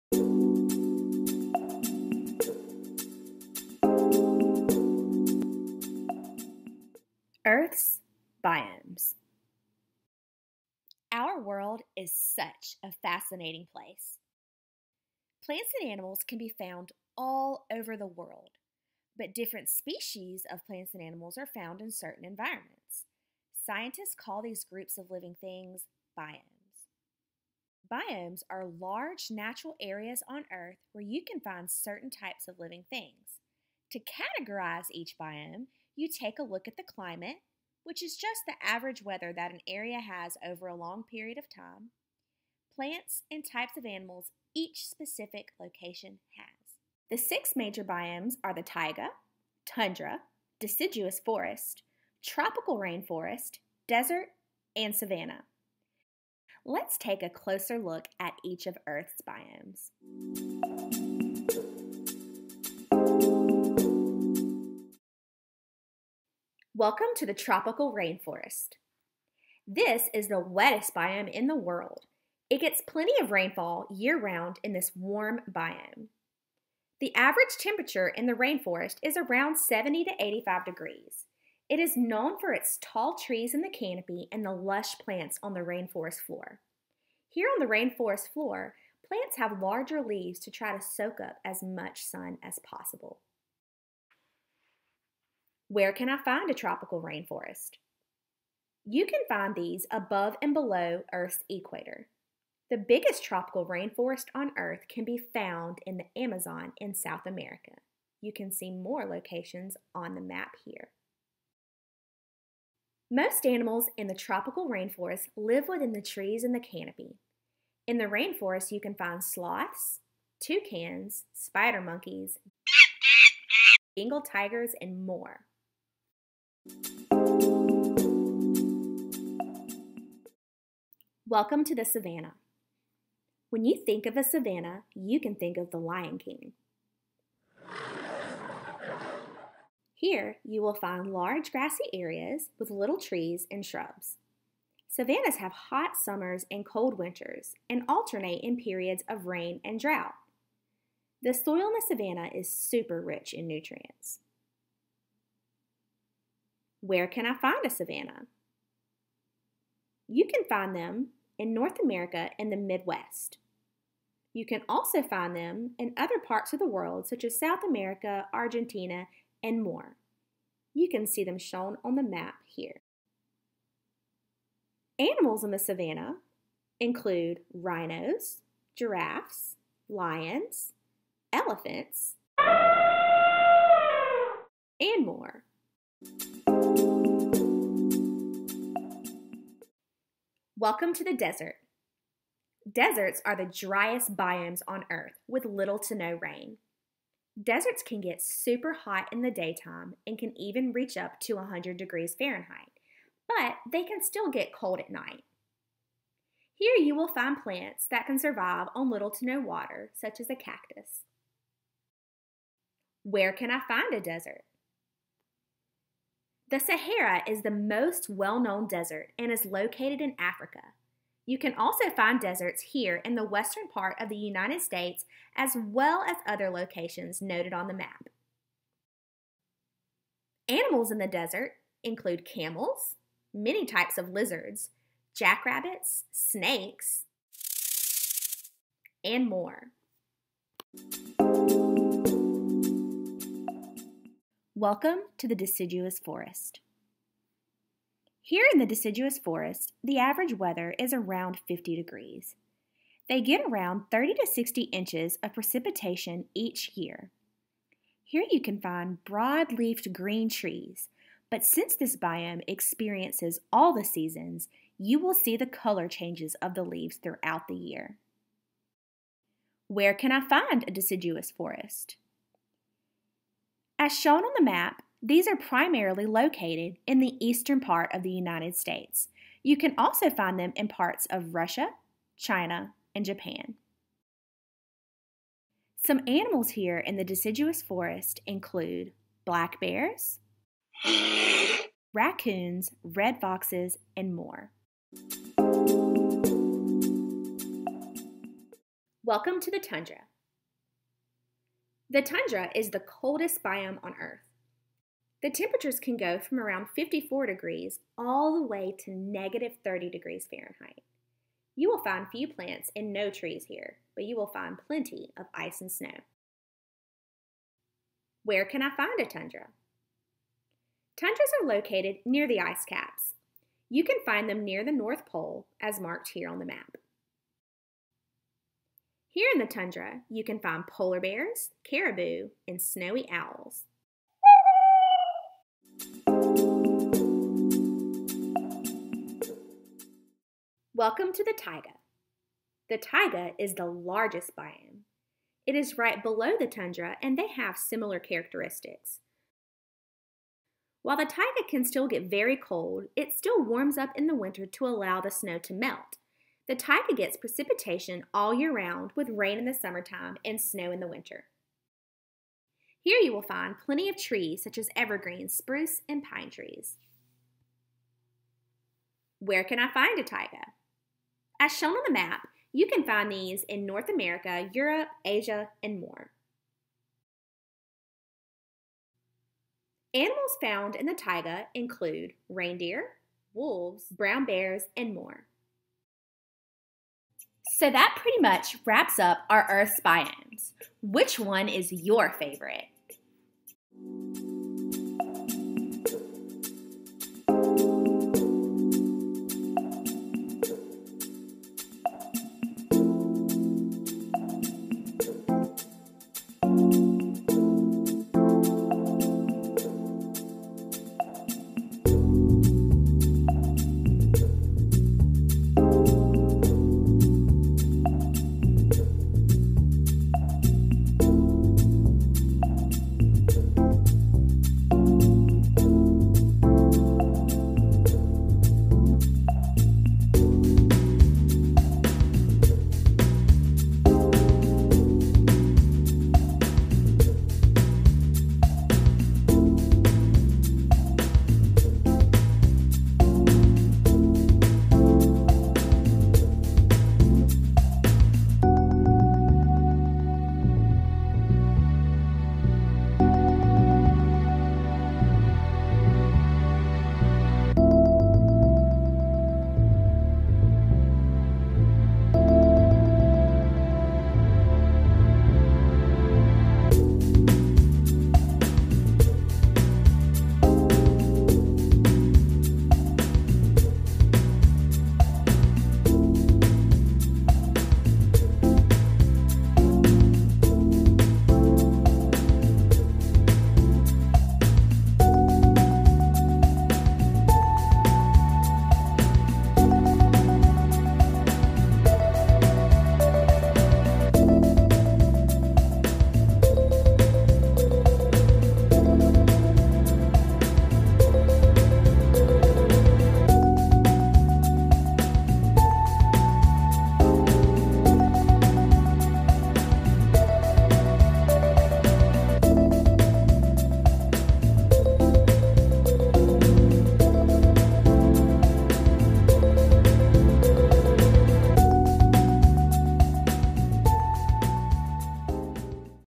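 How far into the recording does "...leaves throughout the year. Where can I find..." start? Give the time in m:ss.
4:26.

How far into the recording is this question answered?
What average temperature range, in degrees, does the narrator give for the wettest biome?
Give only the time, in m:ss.
1:19.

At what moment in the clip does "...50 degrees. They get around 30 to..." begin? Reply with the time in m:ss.
4:11.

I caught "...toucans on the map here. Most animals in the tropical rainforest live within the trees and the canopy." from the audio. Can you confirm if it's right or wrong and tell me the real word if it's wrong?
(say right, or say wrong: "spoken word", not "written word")
wrong: "locations", not "toucans".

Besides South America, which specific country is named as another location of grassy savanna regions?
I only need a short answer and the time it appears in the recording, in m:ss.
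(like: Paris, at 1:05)
Argentina, at 2:48.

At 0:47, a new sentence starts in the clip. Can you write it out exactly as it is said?
The six major biomes are the taiga, tundra, deciduous forest, tropical rainforest, desert, and savanna.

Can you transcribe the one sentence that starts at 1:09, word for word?
This is the wettest biome in the world.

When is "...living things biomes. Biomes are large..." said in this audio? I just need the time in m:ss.
0:25.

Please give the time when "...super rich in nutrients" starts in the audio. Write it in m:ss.
2:32.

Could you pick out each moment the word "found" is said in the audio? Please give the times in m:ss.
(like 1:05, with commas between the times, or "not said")
0:16, 0:21, 1:45, 6:20.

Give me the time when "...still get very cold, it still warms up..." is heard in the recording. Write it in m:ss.
5:51.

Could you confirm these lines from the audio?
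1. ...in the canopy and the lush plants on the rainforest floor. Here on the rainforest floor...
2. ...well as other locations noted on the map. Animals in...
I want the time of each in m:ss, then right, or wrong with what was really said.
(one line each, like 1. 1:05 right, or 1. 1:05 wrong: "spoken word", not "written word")
1. 1:23 right
2. 3:45 right.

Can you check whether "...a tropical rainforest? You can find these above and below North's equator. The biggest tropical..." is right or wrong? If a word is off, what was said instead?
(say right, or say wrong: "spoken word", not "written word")
wrong: "Earth", not "North".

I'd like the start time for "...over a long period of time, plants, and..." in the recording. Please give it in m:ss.
0:40.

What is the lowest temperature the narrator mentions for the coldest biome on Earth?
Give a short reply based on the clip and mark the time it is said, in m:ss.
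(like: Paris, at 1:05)
-30 degrees Fahrenheit, at 5:08.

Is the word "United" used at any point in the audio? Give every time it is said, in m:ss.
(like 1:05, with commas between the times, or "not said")
3:44, 4:38.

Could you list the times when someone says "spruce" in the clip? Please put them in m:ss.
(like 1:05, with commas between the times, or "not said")
6:05.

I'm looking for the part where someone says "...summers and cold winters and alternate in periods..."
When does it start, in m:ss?
2:25.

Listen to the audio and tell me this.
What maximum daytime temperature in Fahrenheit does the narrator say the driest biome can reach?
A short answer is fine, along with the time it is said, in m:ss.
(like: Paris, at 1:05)
100 degrees Fahrenheit, at 3:21.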